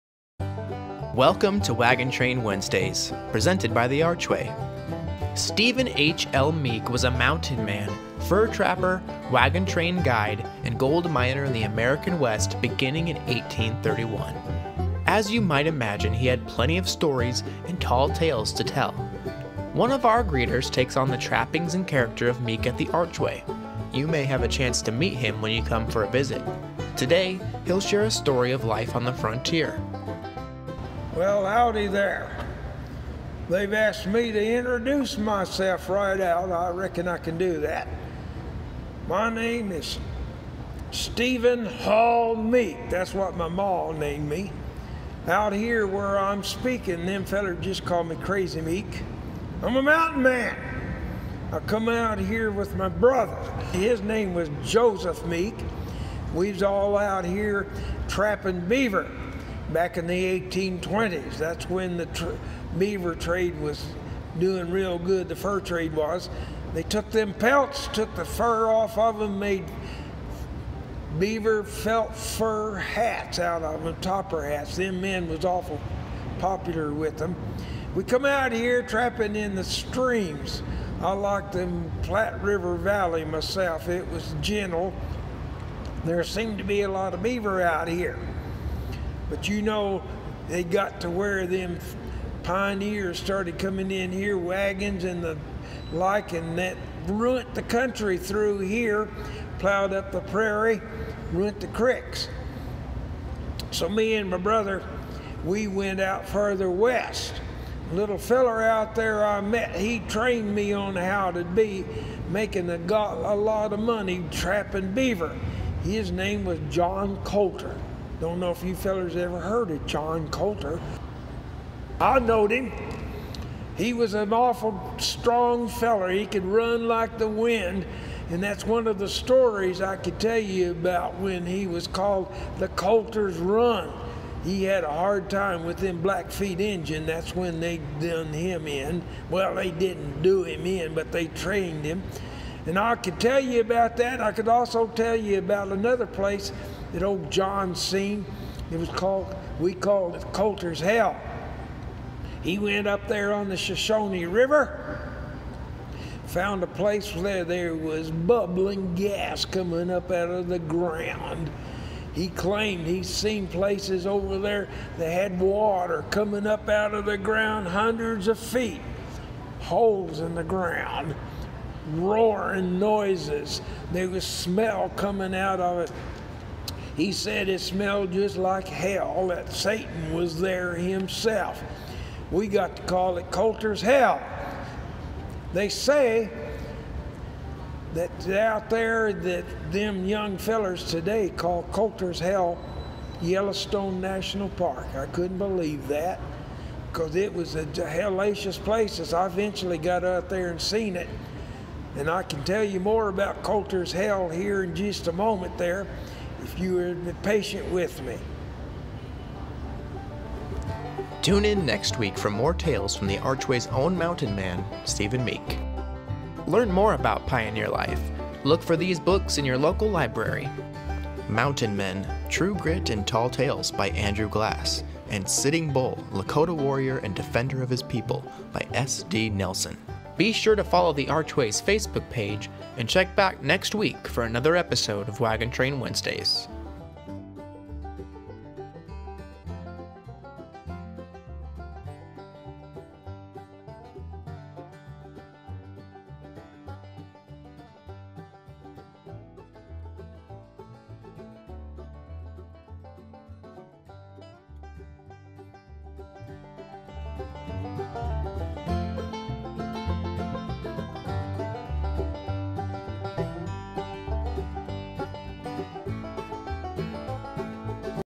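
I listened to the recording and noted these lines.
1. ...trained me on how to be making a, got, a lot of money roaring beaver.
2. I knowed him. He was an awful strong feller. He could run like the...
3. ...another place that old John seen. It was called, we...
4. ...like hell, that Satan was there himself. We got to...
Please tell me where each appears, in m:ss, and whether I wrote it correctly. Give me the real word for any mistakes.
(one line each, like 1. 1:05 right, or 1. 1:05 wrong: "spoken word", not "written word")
1. 1:50 wrong: "trapping", not "roaring"
2. 2:01 right
3. 2:25 right
4. 2:58 right.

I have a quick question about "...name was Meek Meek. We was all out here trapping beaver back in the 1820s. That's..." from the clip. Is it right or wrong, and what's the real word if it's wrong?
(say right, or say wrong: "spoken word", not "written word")
wrong: "Joseph", not "Meek".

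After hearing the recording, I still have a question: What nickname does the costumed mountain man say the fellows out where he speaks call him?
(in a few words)
Crazy Meek.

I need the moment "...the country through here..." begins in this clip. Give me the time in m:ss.
1:37.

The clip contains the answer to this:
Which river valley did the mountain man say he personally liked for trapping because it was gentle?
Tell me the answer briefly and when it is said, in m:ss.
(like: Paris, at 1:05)
Platte River Valley, at 1:22.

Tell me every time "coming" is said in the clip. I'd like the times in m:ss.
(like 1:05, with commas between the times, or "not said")
1:33, 2:39, 2:46, 2:54.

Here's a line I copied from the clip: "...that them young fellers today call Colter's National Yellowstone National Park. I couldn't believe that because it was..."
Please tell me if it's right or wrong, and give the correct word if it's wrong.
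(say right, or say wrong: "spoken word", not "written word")
wrong: "Hell", not "National".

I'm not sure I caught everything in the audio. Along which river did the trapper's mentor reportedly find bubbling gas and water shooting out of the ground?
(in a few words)
Shoshone River.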